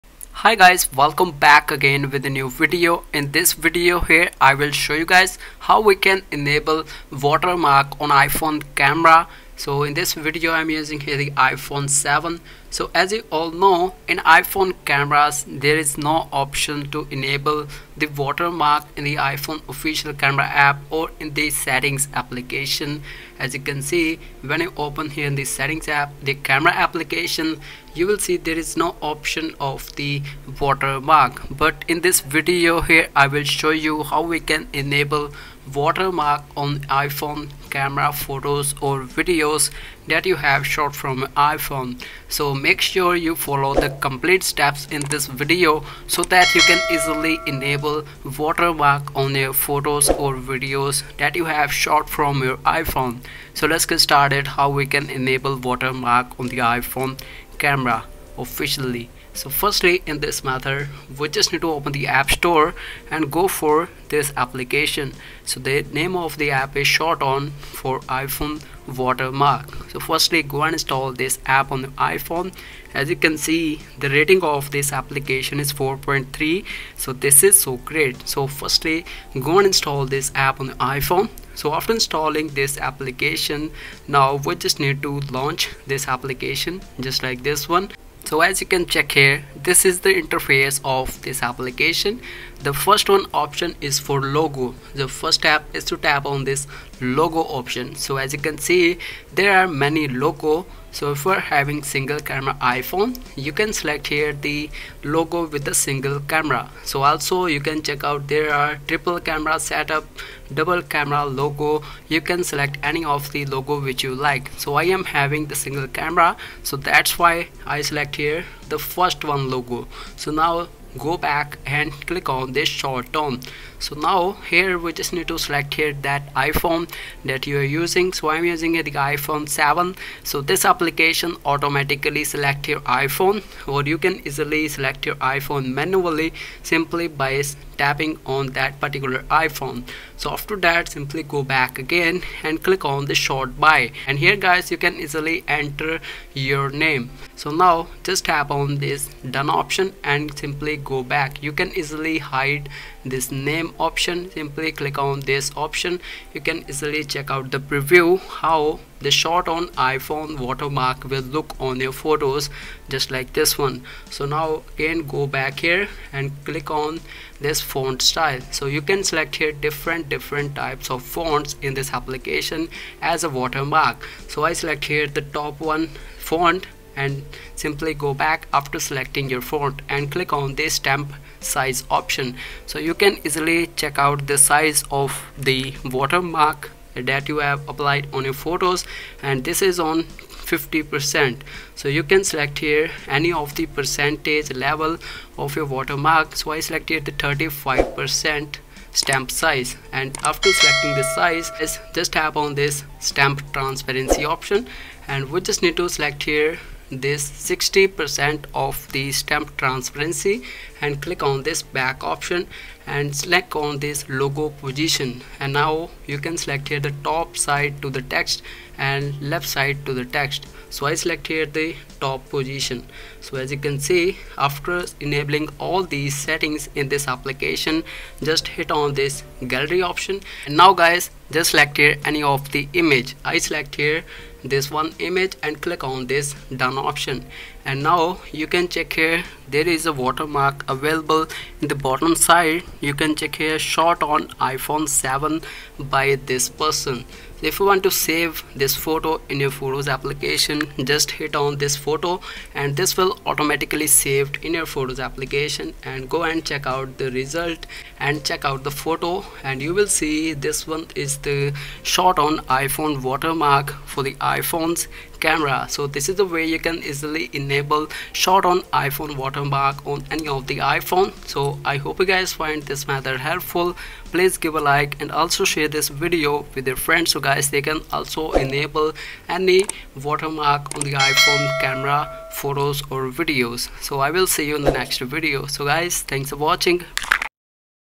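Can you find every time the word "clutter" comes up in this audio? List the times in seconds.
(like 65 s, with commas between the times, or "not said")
not said.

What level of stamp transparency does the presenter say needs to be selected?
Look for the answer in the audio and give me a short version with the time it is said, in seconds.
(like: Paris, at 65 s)
60%, at 207 s.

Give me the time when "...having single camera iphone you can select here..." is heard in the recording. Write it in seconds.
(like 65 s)
101 s.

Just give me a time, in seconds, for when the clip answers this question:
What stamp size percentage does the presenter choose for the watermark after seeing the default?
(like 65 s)
197 s.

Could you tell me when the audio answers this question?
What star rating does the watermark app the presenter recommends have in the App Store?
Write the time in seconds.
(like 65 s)
75 s.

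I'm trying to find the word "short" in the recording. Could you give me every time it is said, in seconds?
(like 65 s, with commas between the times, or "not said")
122 s, 143 s.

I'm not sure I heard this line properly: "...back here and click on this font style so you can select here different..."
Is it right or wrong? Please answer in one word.
right.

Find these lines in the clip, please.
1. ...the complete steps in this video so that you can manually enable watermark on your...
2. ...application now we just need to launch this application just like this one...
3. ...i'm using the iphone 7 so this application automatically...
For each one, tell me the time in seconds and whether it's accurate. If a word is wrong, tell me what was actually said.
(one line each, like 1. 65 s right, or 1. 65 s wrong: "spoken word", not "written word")
1. 43 s wrong: "easily", not "manually"
2. 82 s right
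3. 128 s right.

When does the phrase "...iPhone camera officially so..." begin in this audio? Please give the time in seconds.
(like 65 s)
56 s.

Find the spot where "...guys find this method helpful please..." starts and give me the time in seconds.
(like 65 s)
272 s.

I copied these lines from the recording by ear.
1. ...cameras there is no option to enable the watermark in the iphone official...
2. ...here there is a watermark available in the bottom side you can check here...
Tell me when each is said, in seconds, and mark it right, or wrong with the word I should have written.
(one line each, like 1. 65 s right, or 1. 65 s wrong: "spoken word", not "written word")
1. 14 s right
2. 238 s right.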